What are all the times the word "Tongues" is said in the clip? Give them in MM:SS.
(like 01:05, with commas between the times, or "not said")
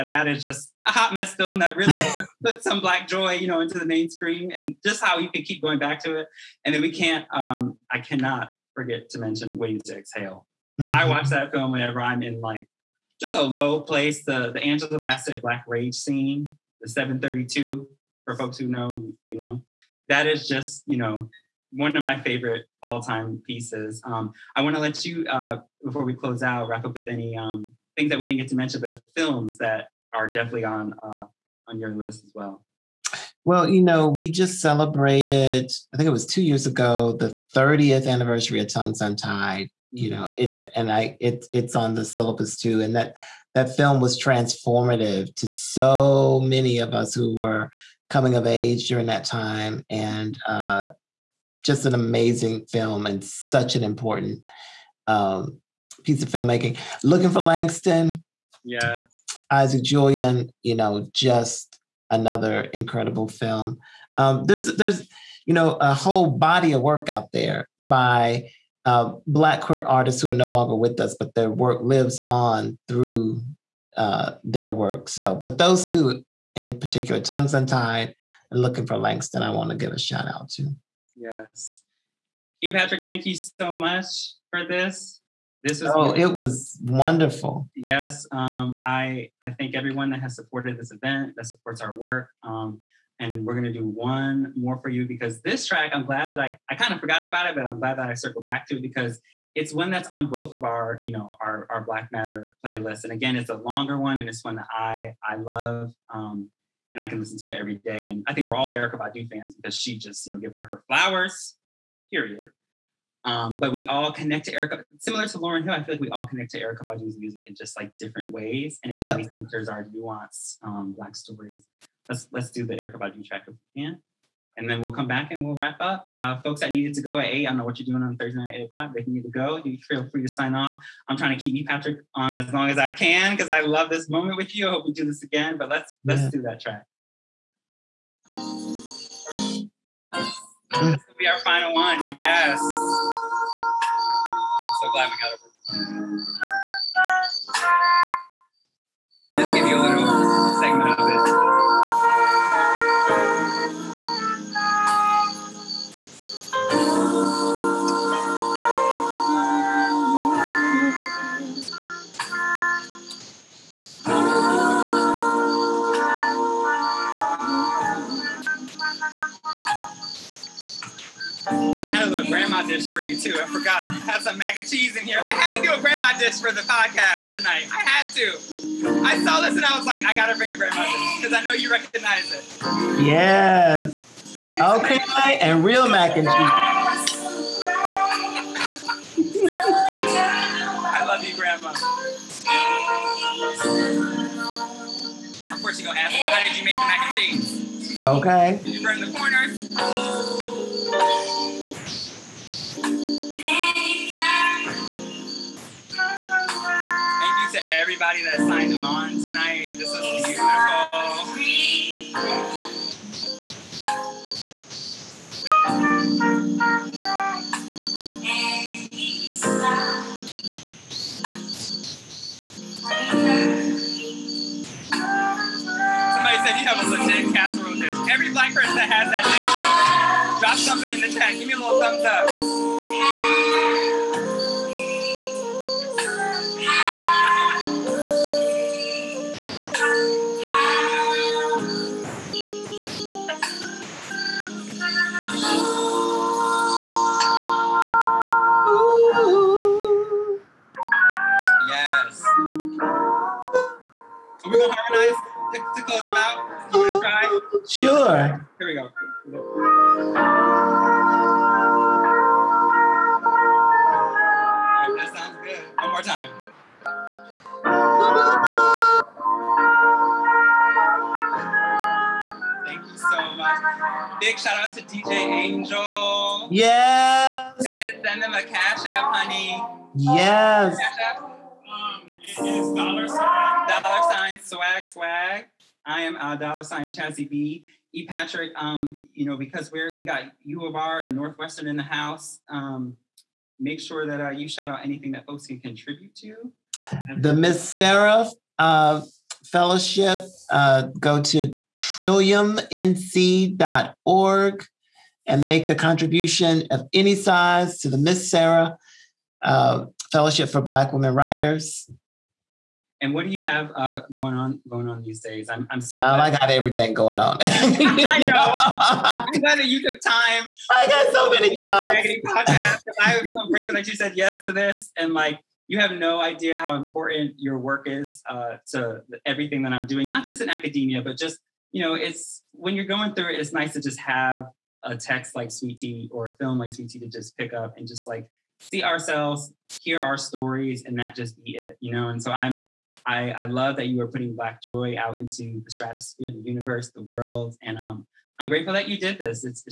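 00:38, 01:17.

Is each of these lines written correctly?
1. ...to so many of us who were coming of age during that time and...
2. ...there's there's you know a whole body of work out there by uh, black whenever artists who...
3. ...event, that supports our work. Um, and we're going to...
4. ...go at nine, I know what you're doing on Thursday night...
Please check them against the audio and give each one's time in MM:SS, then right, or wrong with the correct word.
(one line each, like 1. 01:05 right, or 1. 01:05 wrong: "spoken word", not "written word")
1. 00:45 right
2. 01:04 wrong: "queer", not "whenever"
3. 01:30 right
4. 02:07 wrong: "eight", not "nine".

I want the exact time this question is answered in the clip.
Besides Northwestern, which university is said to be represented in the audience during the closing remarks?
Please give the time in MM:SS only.
04:50.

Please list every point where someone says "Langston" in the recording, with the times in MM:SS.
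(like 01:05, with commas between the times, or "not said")
00:57, 01:18.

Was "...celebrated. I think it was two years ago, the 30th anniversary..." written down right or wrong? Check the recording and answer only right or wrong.
right.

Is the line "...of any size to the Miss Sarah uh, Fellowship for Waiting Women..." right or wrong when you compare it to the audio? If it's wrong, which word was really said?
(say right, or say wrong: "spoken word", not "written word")
wrong: "Black", not "Waiting".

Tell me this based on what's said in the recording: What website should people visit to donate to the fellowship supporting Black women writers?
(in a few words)
trilliumnc.org.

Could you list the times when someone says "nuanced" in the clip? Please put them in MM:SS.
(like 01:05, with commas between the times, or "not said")
01:59.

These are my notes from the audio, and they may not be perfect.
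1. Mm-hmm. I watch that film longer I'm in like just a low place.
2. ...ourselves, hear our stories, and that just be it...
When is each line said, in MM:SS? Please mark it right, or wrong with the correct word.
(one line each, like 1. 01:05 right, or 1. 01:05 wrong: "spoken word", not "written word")
1. 00:10 wrong: "whenever", not "longer"
2. 05:38 right.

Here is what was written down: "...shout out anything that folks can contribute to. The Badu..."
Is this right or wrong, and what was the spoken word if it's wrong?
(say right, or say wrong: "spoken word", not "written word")
wrong: "Miss", not "Badu".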